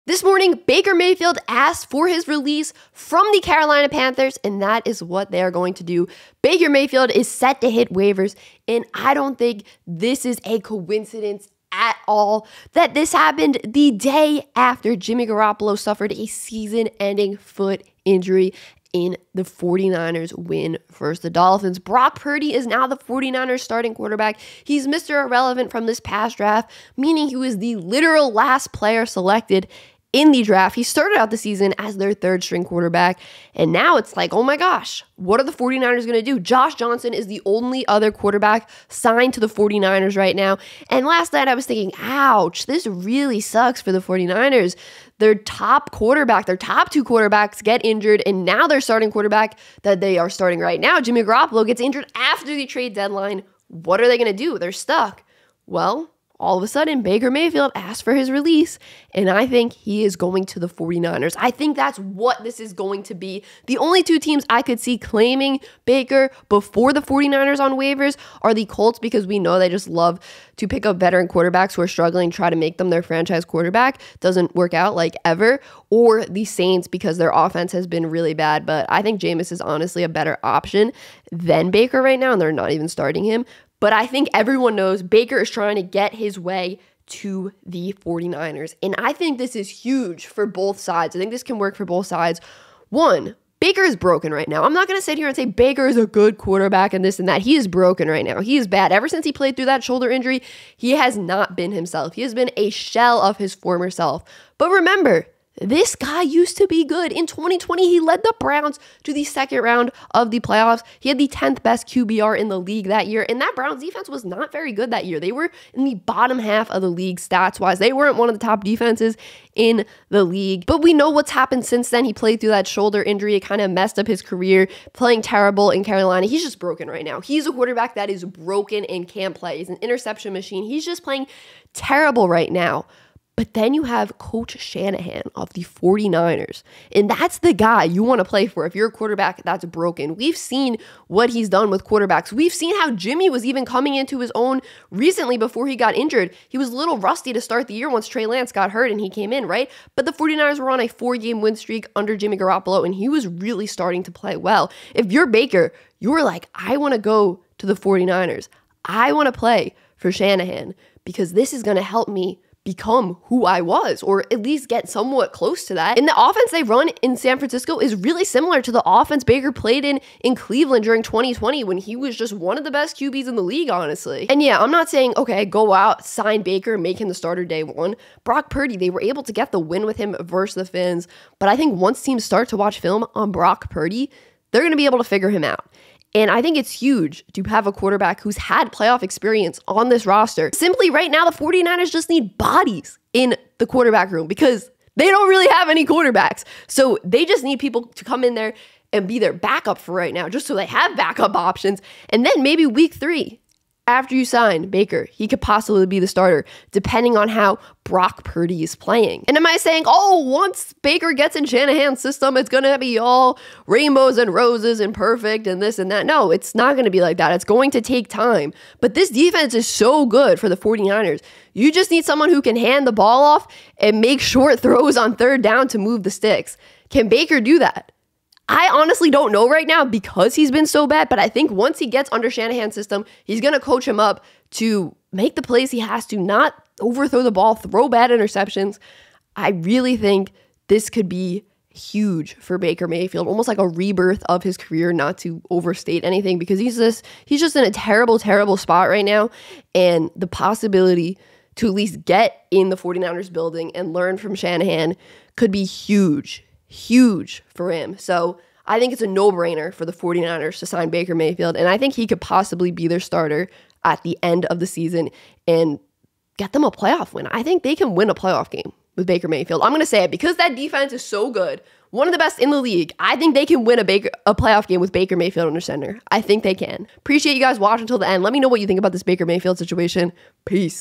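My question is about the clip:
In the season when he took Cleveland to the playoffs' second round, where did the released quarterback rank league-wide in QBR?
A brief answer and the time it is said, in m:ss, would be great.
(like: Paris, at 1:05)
10th, at 1:51.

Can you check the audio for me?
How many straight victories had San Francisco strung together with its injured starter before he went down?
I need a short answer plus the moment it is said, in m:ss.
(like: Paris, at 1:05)
4, at 2:30.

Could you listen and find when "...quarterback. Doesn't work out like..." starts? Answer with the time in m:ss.
1:13.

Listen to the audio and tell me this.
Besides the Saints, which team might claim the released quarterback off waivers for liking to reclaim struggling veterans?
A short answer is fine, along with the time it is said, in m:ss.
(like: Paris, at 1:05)
Colts, at 1:08.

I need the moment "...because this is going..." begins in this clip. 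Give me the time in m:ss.
2:41.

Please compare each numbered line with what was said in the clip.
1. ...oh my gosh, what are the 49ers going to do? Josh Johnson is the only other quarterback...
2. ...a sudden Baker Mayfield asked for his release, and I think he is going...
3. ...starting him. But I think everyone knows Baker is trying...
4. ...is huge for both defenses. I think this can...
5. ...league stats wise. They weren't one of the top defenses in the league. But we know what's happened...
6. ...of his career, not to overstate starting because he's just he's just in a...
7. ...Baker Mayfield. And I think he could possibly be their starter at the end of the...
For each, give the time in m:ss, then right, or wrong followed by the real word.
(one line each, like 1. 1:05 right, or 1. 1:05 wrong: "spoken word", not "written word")
1. 0:34 right
2. 0:56 right
3. 1:22 right
4. 1:29 wrong: "sides", not "defenses"
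5. 1:56 right
6. 4:04 wrong: "anything", not "starting"
7. 4:20 right.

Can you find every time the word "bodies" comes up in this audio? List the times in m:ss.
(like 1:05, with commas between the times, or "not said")
3:12.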